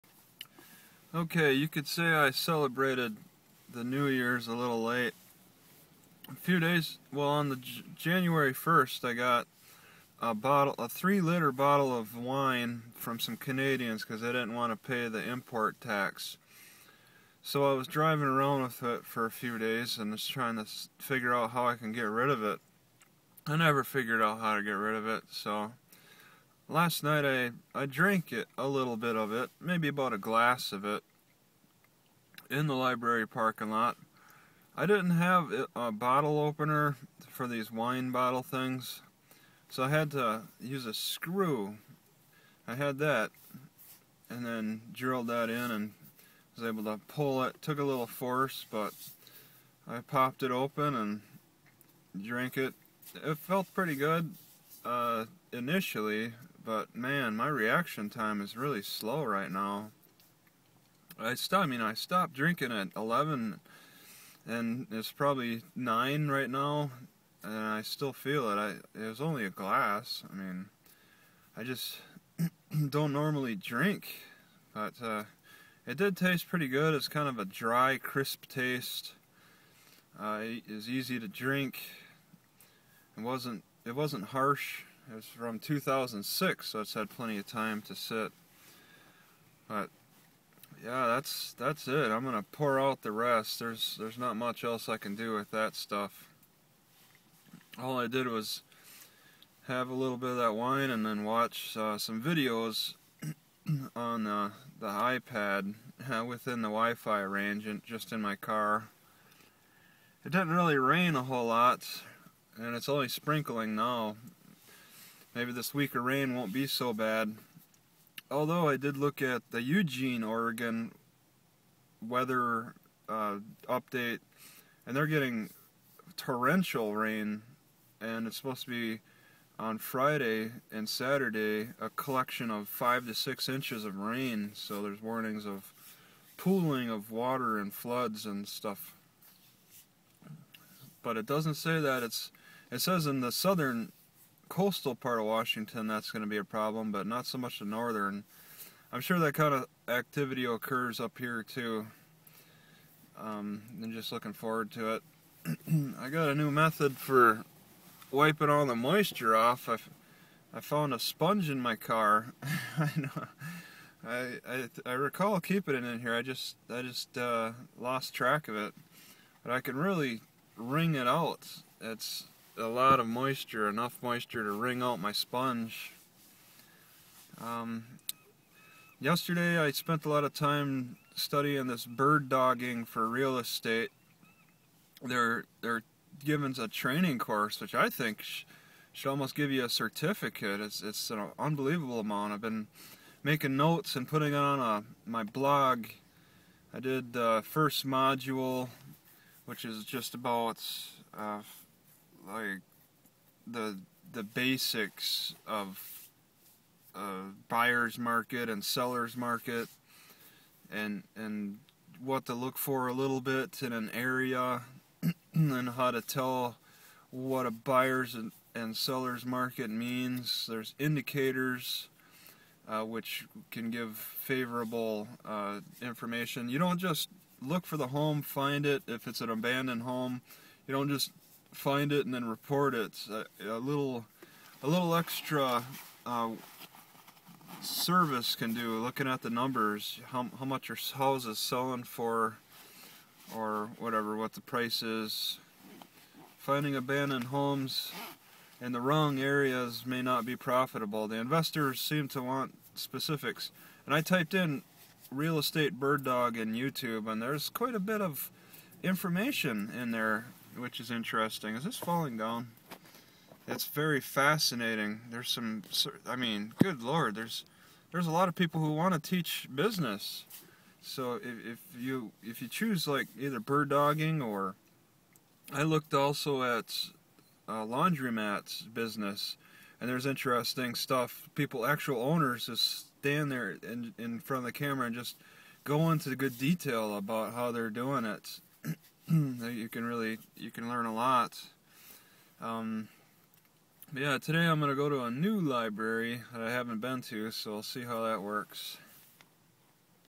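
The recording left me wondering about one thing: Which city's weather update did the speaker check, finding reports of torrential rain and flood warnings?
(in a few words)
Eugene, Oregon.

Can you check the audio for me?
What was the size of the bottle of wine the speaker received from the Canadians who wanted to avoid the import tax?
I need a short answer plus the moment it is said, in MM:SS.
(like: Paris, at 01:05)
3 liters, at 00:10.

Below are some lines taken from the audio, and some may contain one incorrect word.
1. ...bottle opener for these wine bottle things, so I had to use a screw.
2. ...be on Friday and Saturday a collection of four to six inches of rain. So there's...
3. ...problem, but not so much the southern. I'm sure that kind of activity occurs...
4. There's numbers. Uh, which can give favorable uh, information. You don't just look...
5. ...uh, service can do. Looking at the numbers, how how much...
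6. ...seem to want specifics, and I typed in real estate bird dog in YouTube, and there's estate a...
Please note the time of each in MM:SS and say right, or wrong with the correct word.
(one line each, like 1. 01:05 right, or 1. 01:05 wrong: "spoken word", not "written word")
1. 00:35 right
2. 02:08 wrong: "five", not "four"
3. 02:26 wrong: "northern", not "southern"
4. 03:40 wrong: "indicators", not "numbers"
5. 03:56 right
6. 04:11 wrong: "quite", not "estate".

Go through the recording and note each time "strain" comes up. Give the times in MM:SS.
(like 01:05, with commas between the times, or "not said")
not said.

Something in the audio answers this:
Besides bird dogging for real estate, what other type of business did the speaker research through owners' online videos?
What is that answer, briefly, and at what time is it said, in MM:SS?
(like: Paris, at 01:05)
laundromats, at 04:37.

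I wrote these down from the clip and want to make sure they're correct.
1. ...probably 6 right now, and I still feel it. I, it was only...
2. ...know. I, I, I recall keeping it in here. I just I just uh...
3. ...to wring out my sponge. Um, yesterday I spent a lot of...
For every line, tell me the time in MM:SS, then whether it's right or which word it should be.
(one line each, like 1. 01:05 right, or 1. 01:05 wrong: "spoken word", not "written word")
1. 01:05 wrong: "9", not "6"
2. 02:42 right
3. 02:54 right.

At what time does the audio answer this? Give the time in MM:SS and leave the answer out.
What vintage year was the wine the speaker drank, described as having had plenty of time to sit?
01:25.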